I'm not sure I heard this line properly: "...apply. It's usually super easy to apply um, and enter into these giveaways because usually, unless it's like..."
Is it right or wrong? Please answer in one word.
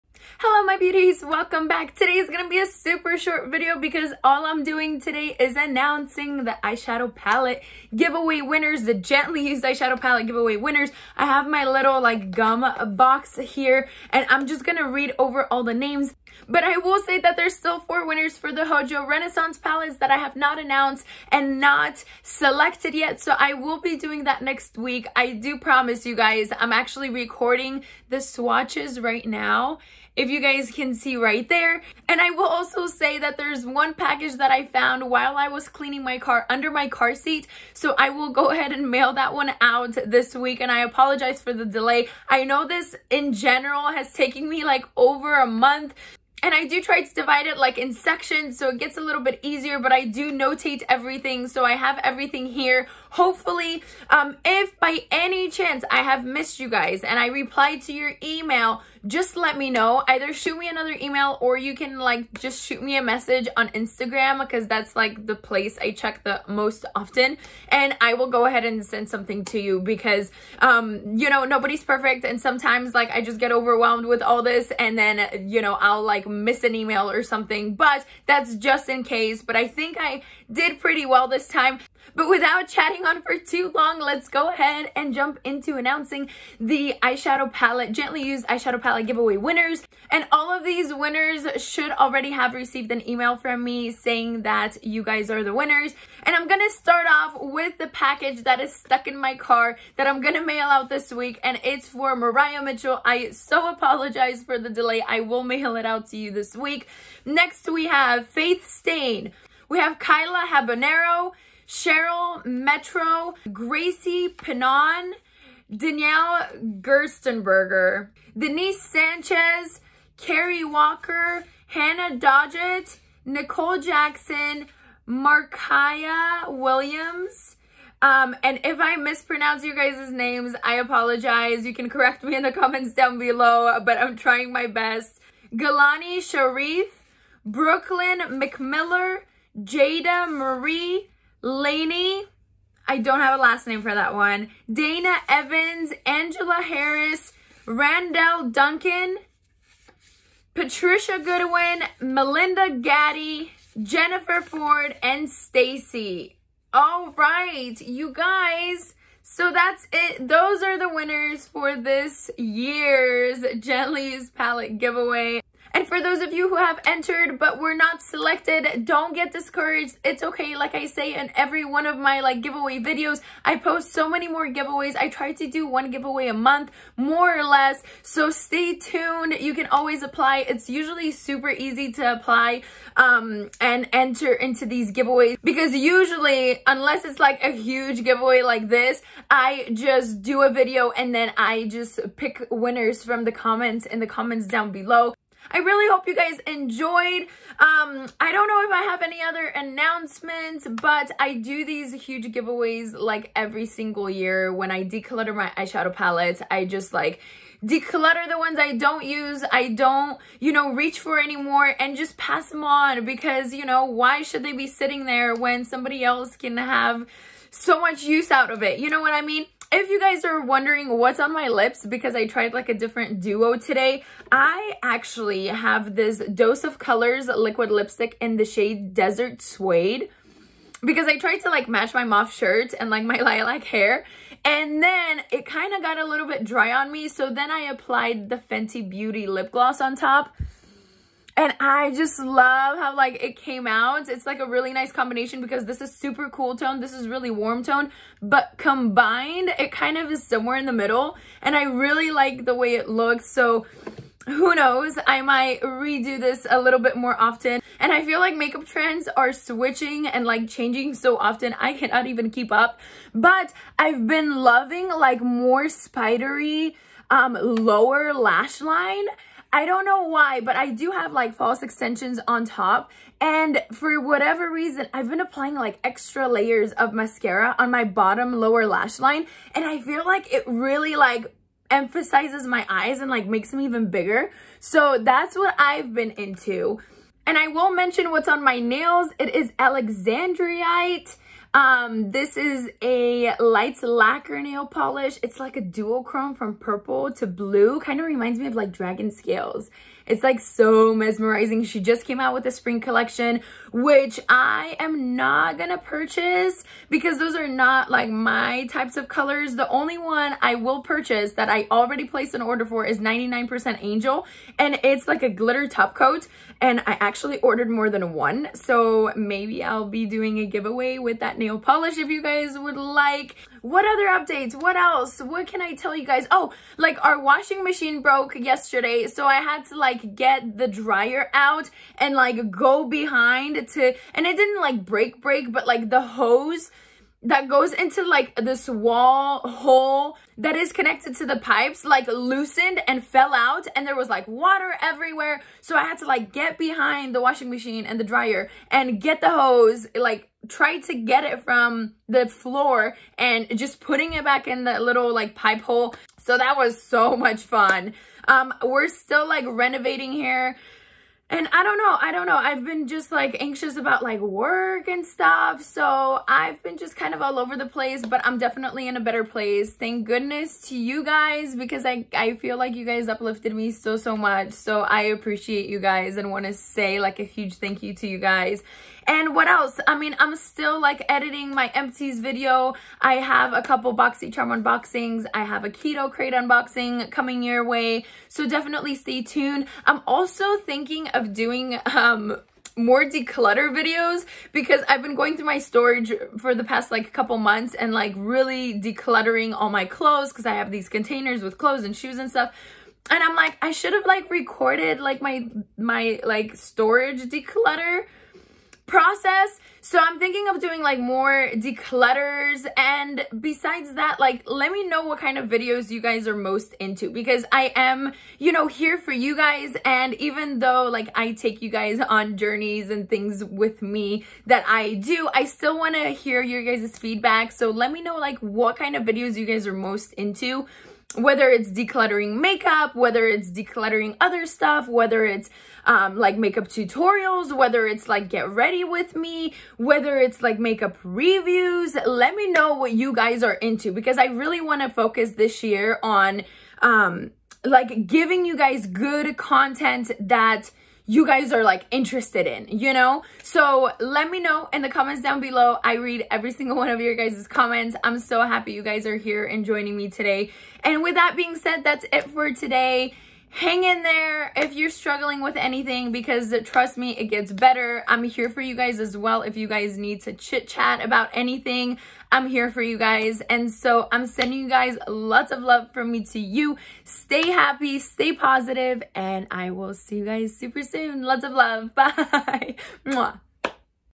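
right.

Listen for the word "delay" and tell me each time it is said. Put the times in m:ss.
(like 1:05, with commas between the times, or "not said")
0:41, 1:44.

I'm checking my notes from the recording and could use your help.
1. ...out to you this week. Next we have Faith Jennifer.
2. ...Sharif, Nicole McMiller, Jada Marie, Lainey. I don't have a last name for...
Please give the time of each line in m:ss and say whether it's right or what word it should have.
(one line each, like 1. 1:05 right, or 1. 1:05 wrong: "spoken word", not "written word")
1. 1:45 wrong: "Stain", not "Jennifer"
2. 2:16 wrong: "Brooklyn", not "Nicole".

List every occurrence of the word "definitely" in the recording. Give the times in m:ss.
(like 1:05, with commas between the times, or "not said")
6:08, 6:28.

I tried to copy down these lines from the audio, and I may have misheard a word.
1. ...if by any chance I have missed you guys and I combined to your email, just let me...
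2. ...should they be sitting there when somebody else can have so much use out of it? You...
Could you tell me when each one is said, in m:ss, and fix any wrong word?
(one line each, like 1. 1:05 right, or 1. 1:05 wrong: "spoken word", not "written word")
1. 0:54 wrong: "replied", not "combined"
2. 3:34 right.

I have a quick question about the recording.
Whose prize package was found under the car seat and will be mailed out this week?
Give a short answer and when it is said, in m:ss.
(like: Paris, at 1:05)
Mariah Mitchell, at 1:42.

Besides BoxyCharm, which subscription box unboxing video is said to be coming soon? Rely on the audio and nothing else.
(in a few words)
Keto Krate.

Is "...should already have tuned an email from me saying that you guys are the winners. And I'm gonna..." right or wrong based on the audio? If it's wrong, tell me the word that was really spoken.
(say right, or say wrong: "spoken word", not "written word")
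wrong: "received", not "tuned".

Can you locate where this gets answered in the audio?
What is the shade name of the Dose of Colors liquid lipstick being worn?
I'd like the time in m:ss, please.
3:48.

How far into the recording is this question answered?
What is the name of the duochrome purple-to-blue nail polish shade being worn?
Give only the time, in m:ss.
4:49.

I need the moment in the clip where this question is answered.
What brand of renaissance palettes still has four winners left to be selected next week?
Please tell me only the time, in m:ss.
0:18.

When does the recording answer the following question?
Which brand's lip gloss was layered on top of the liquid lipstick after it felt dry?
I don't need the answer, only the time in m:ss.
3:58.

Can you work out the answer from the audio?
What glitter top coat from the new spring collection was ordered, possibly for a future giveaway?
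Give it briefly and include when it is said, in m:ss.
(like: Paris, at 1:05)
99% Angel, at 5:12.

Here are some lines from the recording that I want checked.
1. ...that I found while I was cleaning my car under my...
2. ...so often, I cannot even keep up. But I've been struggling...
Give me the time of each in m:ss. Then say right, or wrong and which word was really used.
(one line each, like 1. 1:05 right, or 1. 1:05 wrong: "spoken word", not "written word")
1. 0:34 right
2. 4:20 wrong: "loving", not "struggling".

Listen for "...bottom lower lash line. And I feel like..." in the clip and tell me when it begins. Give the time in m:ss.
4:37.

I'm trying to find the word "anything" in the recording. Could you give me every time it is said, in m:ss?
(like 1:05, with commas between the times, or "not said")
7:45, 7:51.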